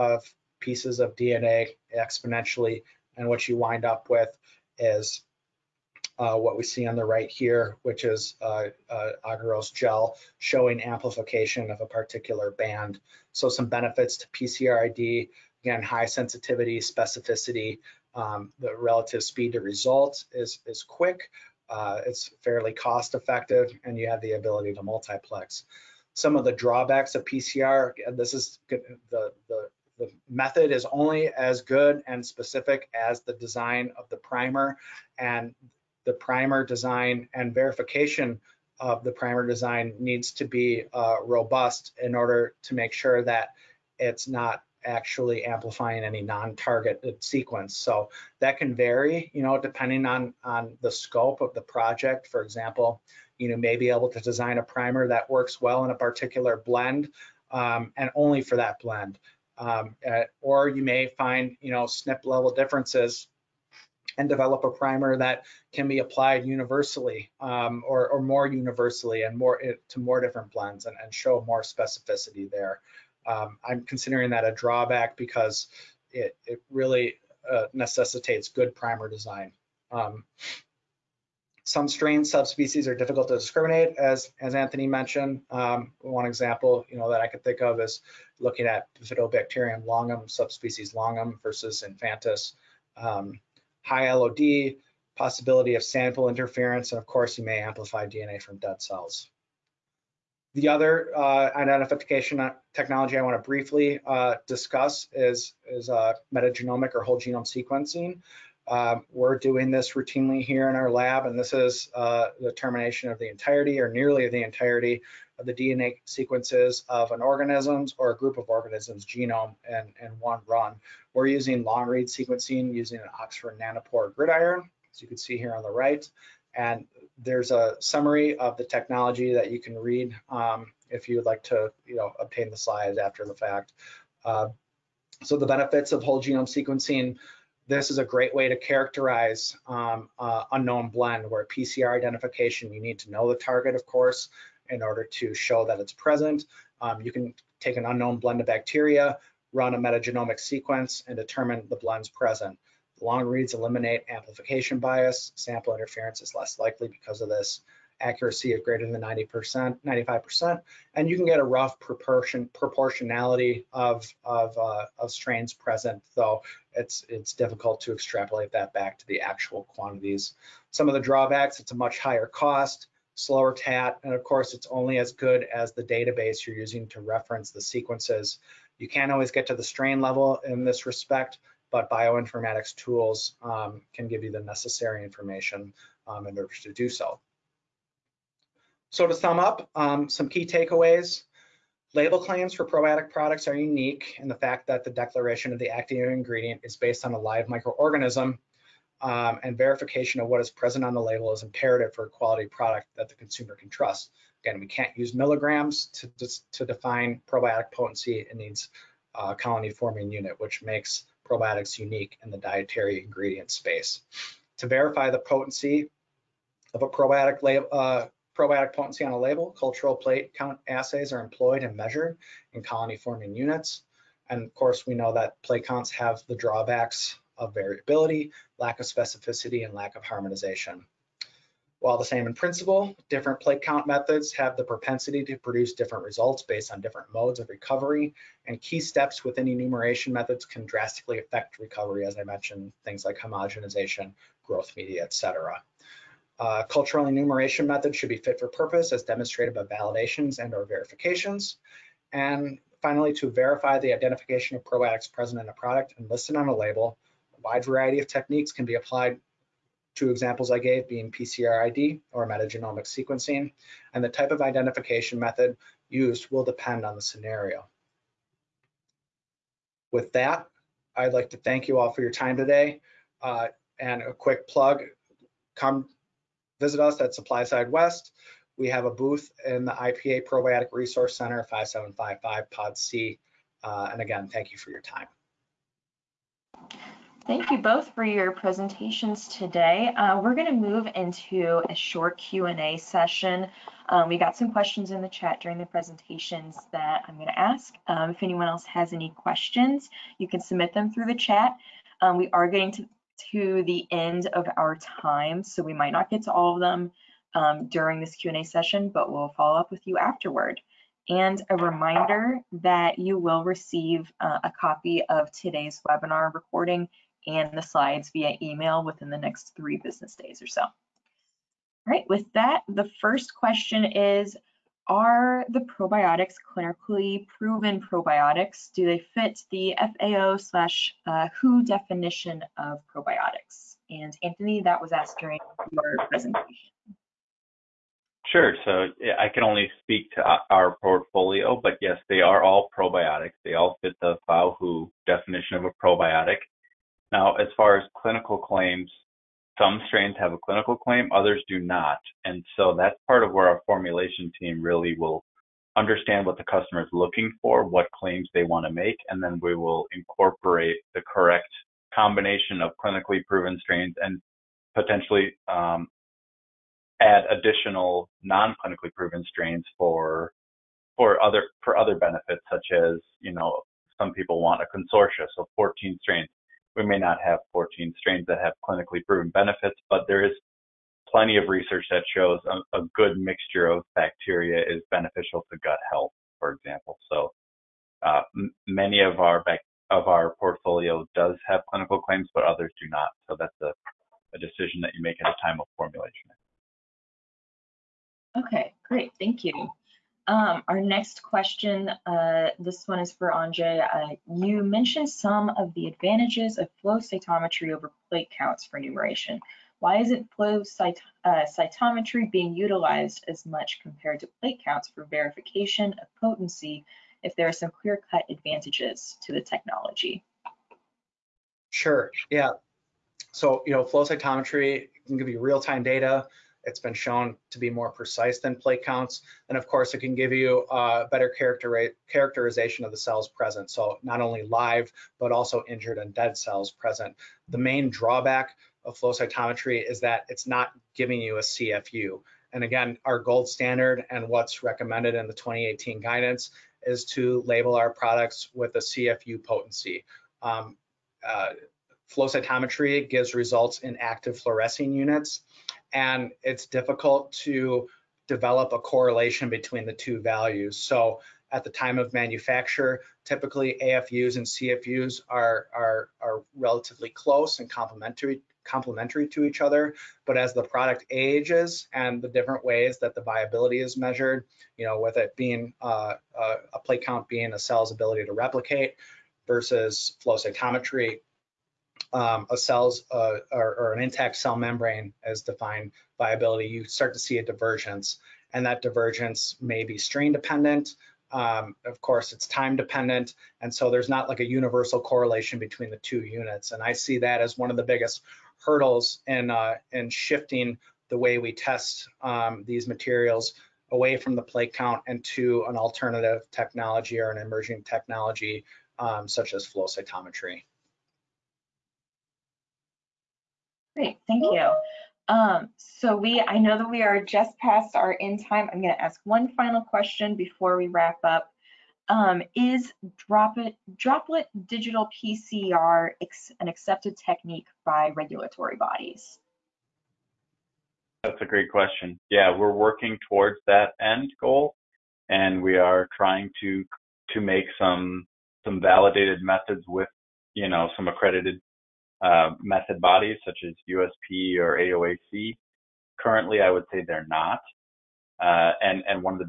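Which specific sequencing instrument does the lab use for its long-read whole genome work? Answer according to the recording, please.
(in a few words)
Oxford Nanopore GridION.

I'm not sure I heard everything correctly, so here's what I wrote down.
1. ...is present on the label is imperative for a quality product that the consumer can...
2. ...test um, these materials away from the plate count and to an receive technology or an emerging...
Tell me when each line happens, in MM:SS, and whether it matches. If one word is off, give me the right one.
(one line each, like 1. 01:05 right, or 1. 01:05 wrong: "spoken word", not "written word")
1. 03:20 right
2. 08:21 wrong: "alternative", not "receive".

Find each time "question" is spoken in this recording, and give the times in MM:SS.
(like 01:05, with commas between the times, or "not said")
04:54, 04:59, 05:23, 06:41, 08:39, 08:51.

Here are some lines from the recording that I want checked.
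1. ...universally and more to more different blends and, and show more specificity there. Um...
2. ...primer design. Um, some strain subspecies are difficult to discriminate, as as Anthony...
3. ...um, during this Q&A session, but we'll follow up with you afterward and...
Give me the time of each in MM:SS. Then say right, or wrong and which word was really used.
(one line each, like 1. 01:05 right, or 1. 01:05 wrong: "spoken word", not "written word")
1. 01:08 right
2. 01:18 right
3. 05:07 right.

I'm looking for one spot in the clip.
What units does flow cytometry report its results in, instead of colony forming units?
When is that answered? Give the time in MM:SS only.
07:33.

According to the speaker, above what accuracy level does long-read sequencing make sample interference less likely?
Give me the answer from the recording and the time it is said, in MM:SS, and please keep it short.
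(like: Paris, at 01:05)
95%, at 02:39.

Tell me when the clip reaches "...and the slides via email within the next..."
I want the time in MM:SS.
05:17.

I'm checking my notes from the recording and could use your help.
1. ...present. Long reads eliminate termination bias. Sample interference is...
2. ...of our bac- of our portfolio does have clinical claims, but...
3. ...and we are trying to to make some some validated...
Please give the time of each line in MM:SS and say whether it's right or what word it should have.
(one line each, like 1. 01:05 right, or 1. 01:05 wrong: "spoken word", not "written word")
1. 02:32 wrong: "amplification", not "termination"
2. 06:29 right
3. 08:55 right.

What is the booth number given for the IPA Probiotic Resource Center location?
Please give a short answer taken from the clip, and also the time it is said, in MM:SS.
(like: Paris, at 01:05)
5755, at 04:41.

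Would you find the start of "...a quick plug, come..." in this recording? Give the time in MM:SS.
04:34.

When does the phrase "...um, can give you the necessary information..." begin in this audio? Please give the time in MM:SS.
03:03.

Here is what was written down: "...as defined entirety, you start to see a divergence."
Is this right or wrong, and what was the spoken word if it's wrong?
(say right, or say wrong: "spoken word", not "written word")
wrong: "viability", not "entirety".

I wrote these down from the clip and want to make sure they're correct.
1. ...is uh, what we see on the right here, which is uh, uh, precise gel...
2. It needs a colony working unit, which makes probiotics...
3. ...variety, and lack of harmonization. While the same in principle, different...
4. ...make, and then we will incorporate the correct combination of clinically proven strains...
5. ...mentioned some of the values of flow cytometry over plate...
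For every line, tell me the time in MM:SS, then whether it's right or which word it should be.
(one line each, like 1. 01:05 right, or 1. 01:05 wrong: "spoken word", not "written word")
1. 00:04 wrong: "agarose", not "precise"
2. 03:28 wrong: "forming", not "working"
3. 03:48 wrong: "specificity", not "variety"
4. 05:58 right
5. 06:44 wrong: "advantages", not "values".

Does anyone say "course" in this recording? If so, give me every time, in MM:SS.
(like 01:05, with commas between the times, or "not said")
01:37, 02:23, 02:54, 03:44, 07:09, 08:12.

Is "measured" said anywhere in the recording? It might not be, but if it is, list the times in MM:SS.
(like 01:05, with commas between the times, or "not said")
03:41, 07:53.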